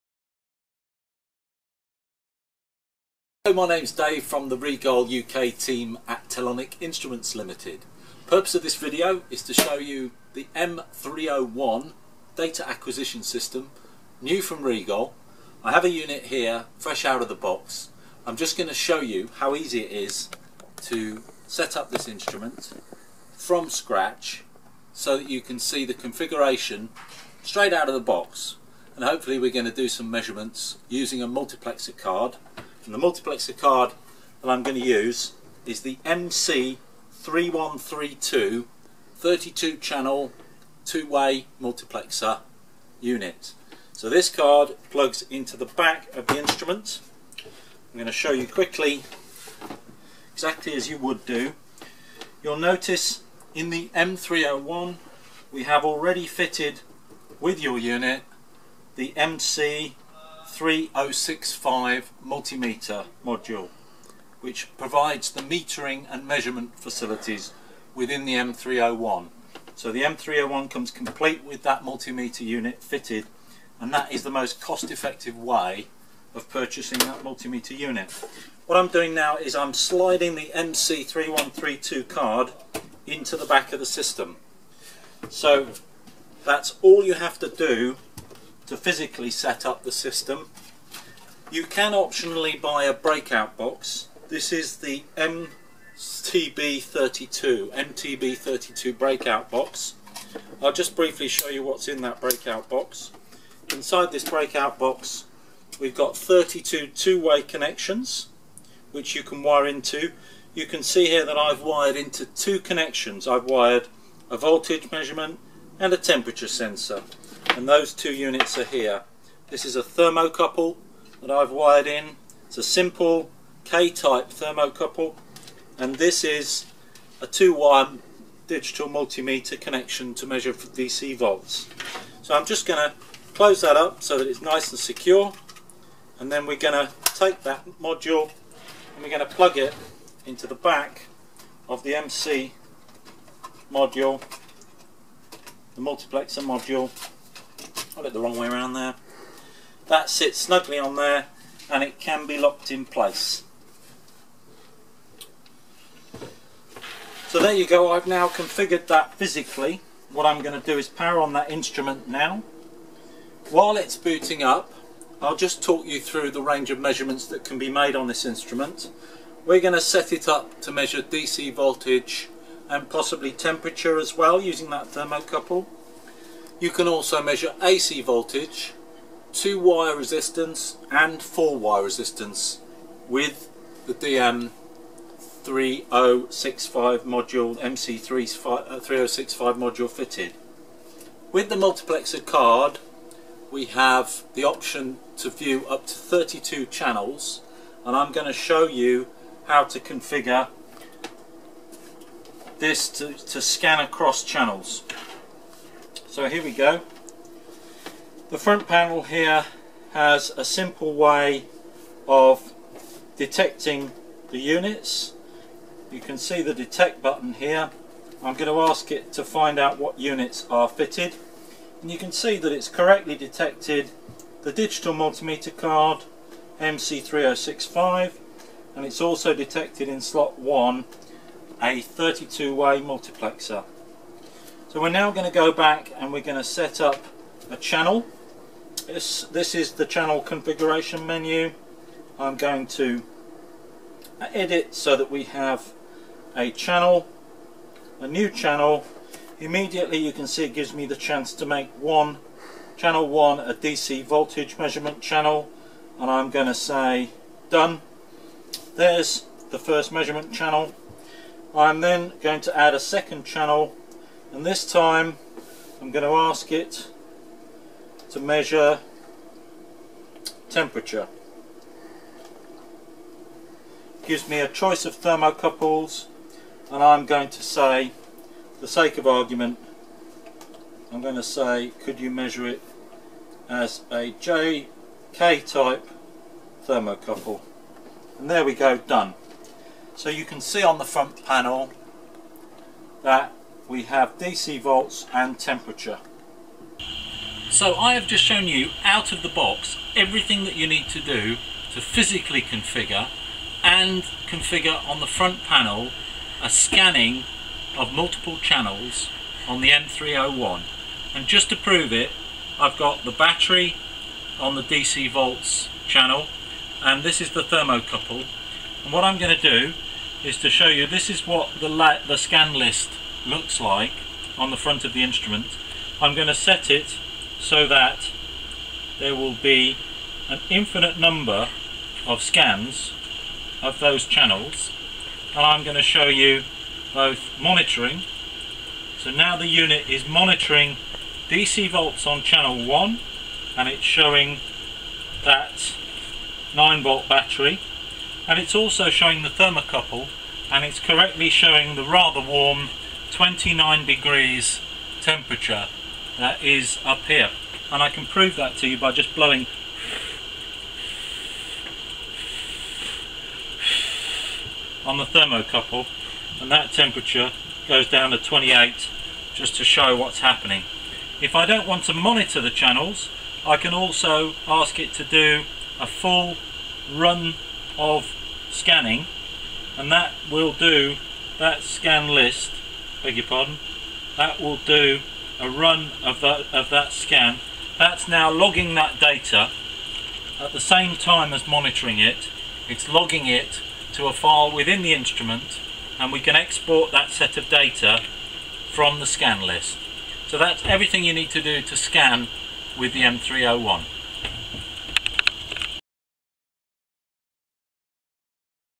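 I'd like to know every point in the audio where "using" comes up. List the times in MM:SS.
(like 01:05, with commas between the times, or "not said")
00:30, 02:54.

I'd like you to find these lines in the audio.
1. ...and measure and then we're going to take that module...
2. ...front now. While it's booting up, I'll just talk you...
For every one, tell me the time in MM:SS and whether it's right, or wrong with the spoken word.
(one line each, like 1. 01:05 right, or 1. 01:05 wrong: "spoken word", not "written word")
1. 02:14 wrong: "secure", not "measure"
2. 02:41 wrong: "instrument", not "front".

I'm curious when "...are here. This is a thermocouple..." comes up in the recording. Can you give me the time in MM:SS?
01:58.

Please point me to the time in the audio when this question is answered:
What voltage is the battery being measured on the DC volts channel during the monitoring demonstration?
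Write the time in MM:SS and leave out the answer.
05:46.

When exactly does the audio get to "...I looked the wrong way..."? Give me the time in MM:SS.
02:27.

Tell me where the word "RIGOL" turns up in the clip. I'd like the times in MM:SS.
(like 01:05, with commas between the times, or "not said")
00:04, 00:14.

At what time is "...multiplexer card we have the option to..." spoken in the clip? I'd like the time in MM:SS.
03:11.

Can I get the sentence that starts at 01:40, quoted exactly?
I'll just briefly show you what's in that breakout box.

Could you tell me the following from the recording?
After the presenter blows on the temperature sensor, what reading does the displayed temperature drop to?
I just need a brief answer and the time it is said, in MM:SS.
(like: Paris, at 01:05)
28 degrees, at 06:08.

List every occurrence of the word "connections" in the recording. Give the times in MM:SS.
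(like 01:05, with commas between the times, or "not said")
01:47, 01:52, 02:09.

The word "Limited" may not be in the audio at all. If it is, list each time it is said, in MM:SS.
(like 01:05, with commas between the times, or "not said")
00:07.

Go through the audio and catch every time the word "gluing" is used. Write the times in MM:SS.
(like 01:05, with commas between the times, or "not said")
not said.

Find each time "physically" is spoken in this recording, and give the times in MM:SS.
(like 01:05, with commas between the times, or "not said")
01:28, 02:39, 05:01.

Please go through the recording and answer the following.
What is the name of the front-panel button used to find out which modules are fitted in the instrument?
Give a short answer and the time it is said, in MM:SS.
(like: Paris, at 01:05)
detect, at 03:36.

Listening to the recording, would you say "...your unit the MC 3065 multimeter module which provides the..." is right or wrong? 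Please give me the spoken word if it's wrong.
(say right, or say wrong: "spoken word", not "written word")
right.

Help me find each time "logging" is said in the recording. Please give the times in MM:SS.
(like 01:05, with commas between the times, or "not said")
06:28, 06:32.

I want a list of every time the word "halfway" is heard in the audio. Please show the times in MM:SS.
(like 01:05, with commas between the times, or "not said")
not said.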